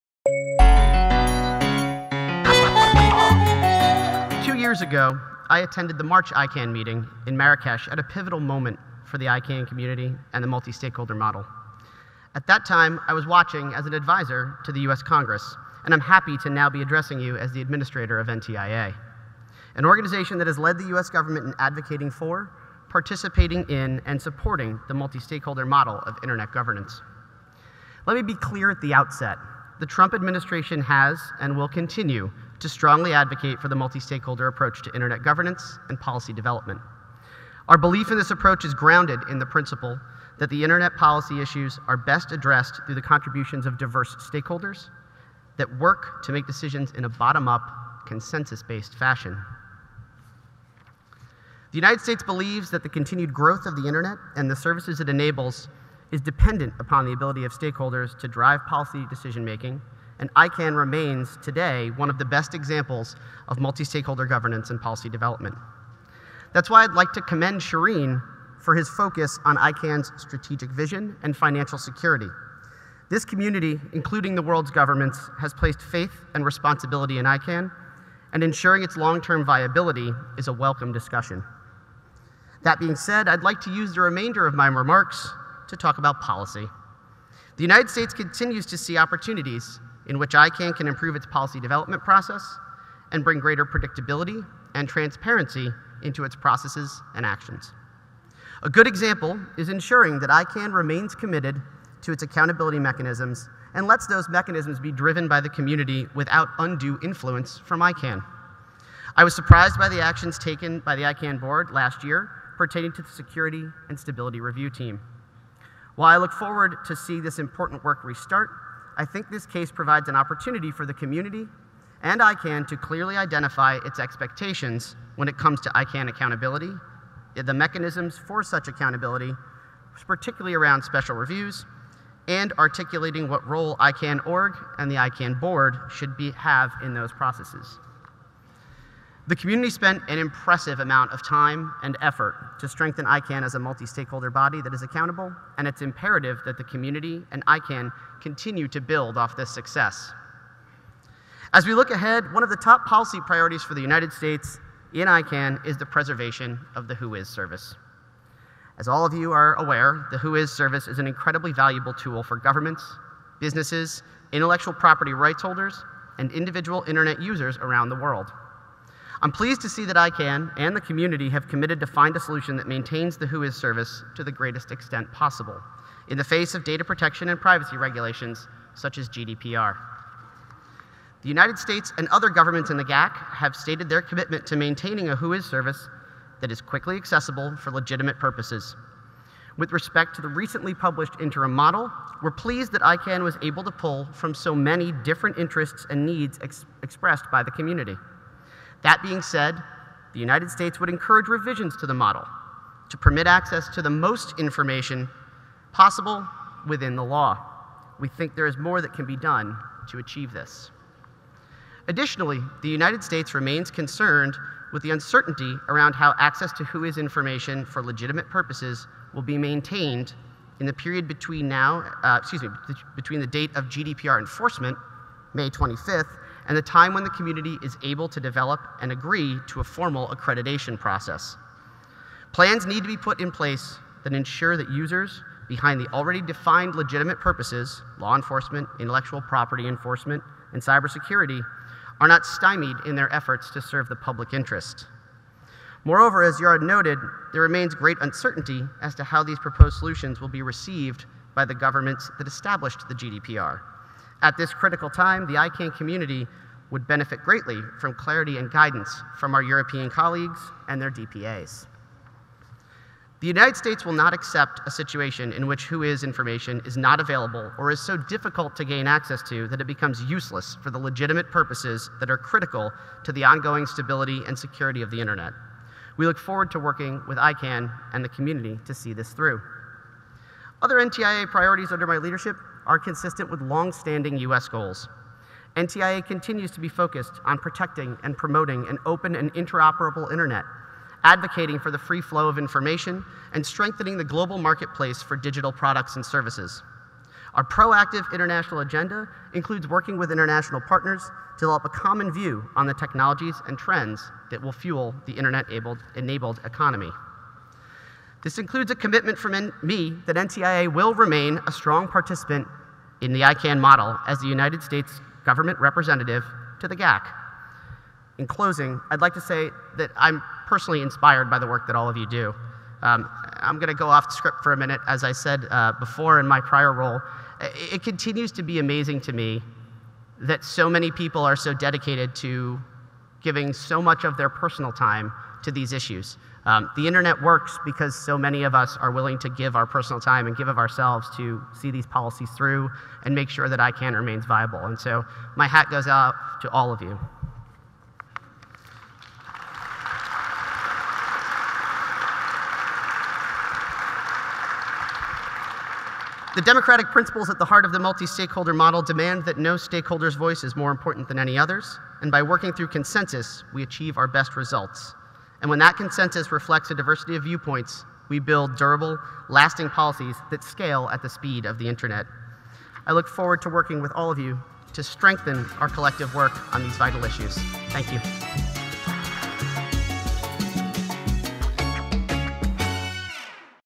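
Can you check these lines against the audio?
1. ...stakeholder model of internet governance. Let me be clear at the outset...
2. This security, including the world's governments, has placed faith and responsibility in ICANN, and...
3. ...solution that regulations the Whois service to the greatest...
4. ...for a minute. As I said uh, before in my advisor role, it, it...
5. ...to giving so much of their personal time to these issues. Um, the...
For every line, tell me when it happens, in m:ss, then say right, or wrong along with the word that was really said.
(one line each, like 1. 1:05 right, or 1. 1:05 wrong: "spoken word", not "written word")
1. 0:25 right
2. 1:13 wrong: "community", not "security"
3. 2:52 wrong: "maintains", not "regulations"
4. 5:24 wrong: "prior", not "advisor"
5. 5:32 right.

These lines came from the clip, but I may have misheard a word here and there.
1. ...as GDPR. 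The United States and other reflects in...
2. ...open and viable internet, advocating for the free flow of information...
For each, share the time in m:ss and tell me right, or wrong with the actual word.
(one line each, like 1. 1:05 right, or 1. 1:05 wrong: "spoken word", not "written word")
1. 2:58 wrong: "governments", not "reflects"
2. 4:48 wrong: "interoperable", not "viable".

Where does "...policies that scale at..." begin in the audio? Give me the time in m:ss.
6:09.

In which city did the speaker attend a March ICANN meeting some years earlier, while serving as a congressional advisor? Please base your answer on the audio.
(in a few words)
Marrakesh.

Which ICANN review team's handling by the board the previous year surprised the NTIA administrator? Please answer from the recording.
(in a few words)
Security and Stability Review Team.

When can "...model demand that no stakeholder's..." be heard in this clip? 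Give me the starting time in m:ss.
5:58.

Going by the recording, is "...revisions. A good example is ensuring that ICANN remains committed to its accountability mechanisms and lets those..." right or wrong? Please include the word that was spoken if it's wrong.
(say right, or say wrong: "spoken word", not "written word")
wrong: "actions", not "revisions".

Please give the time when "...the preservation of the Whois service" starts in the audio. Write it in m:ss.
2:35.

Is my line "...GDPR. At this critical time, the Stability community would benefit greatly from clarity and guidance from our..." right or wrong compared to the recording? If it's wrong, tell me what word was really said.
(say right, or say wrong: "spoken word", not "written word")
wrong: "ICANN", not "Stability".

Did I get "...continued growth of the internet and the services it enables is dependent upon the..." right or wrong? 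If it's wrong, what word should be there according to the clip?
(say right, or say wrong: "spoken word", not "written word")
right.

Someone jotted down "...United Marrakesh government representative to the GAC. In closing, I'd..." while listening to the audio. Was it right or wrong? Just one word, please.
wrong.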